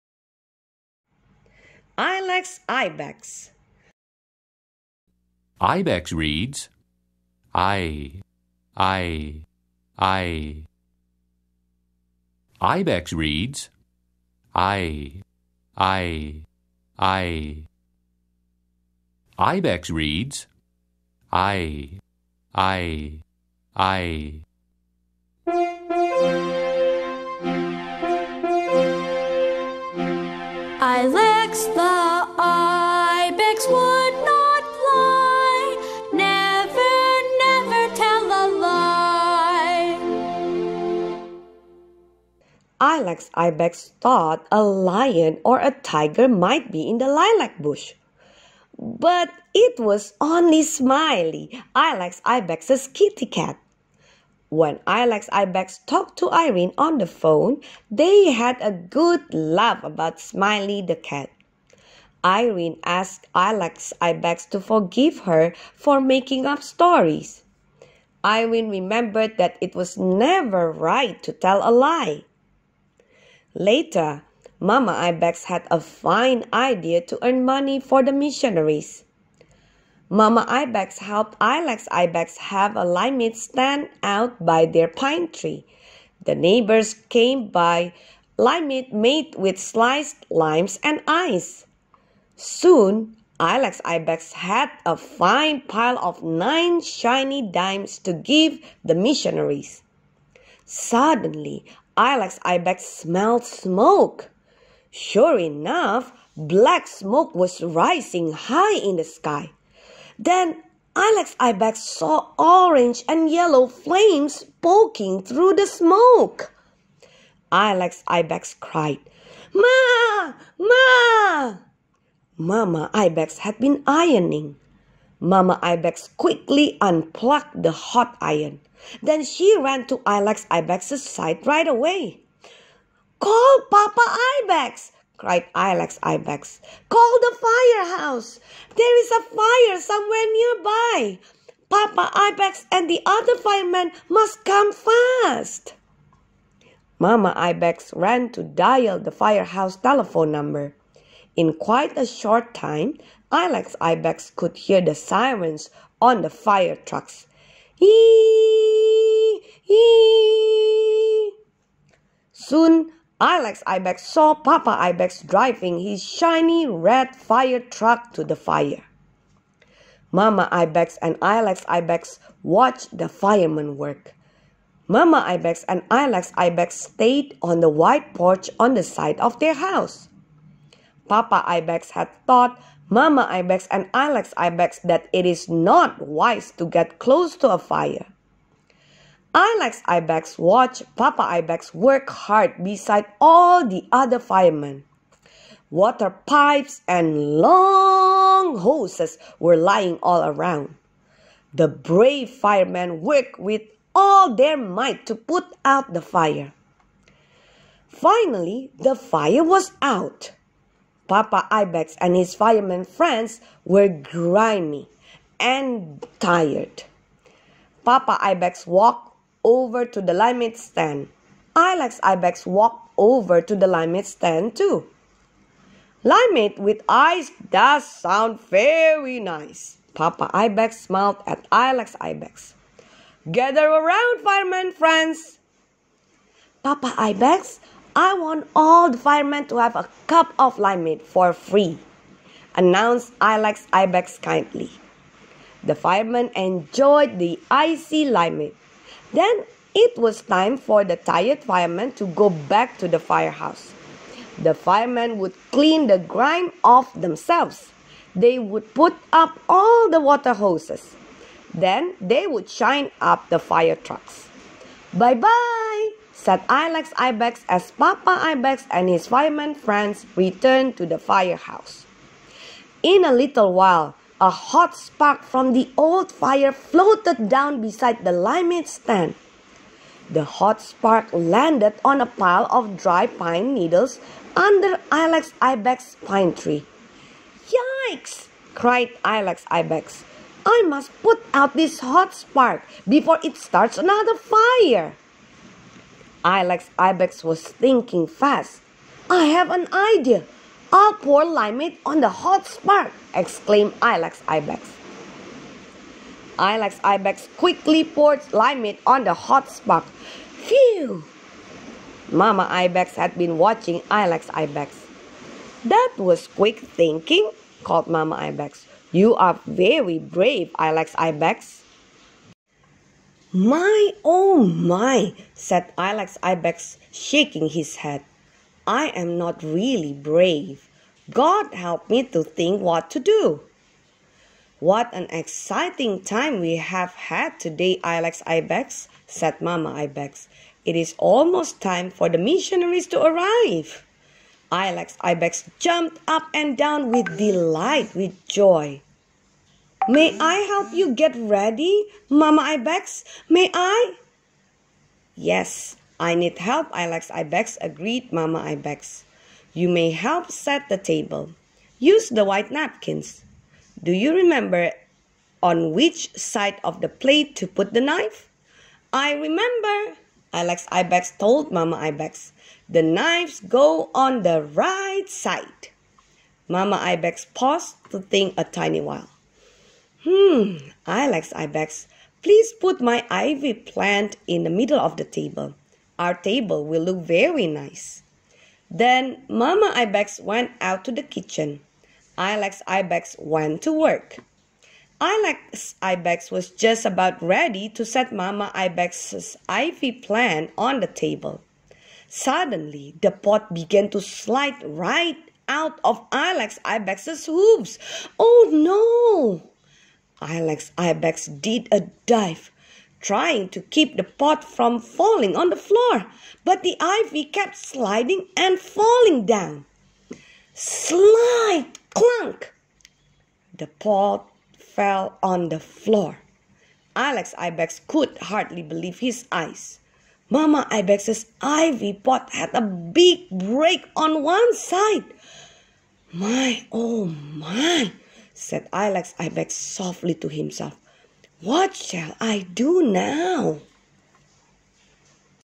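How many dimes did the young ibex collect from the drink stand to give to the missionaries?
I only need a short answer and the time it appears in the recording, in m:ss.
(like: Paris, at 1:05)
9, at 1:36.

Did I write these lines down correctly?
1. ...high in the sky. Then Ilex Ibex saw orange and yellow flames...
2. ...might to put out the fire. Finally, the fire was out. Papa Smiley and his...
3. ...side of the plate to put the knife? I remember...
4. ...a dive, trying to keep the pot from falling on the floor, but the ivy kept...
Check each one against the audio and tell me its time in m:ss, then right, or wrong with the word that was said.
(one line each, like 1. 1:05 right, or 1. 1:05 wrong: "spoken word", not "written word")
1. 1:48 right
2. 3:24 wrong: "Ibex", not "Smiley"
3. 6:06 right
4. 6:51 right.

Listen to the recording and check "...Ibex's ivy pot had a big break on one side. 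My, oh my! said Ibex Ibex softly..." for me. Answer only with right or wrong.
wrong.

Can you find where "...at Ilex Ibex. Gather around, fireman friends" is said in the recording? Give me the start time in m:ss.
3:51.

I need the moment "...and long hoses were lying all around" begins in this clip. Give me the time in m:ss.
3:16.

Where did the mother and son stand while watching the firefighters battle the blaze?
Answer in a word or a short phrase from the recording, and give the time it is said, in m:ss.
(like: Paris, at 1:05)
The wide porch, at 2:57.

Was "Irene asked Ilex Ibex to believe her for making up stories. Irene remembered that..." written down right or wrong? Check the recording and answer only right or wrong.
wrong.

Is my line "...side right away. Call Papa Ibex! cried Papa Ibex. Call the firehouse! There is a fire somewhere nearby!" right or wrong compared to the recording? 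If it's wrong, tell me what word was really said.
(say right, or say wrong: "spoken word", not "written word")
wrong: "Ilex", not "Papa".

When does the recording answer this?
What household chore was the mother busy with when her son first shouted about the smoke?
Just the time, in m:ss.
2:03.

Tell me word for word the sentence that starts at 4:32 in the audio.
In a little while, a hot spark from the old fire floated down beside the limeade stand.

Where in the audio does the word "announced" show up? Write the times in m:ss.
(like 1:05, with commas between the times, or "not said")
4:02.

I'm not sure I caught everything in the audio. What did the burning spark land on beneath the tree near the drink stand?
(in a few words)
Dry pine needles.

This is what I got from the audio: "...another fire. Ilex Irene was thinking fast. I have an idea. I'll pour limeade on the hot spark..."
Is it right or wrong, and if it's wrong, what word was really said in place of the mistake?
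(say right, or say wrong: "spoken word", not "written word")
wrong: "Ibex", not "Irene".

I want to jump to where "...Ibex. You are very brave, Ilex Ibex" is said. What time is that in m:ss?
5:18.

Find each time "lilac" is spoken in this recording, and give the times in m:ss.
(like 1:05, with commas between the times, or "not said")
0:47.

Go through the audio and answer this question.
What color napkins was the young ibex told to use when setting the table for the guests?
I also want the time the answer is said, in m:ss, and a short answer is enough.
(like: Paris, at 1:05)
White, at 6:02.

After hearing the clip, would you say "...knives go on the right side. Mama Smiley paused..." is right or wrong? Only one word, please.
wrong.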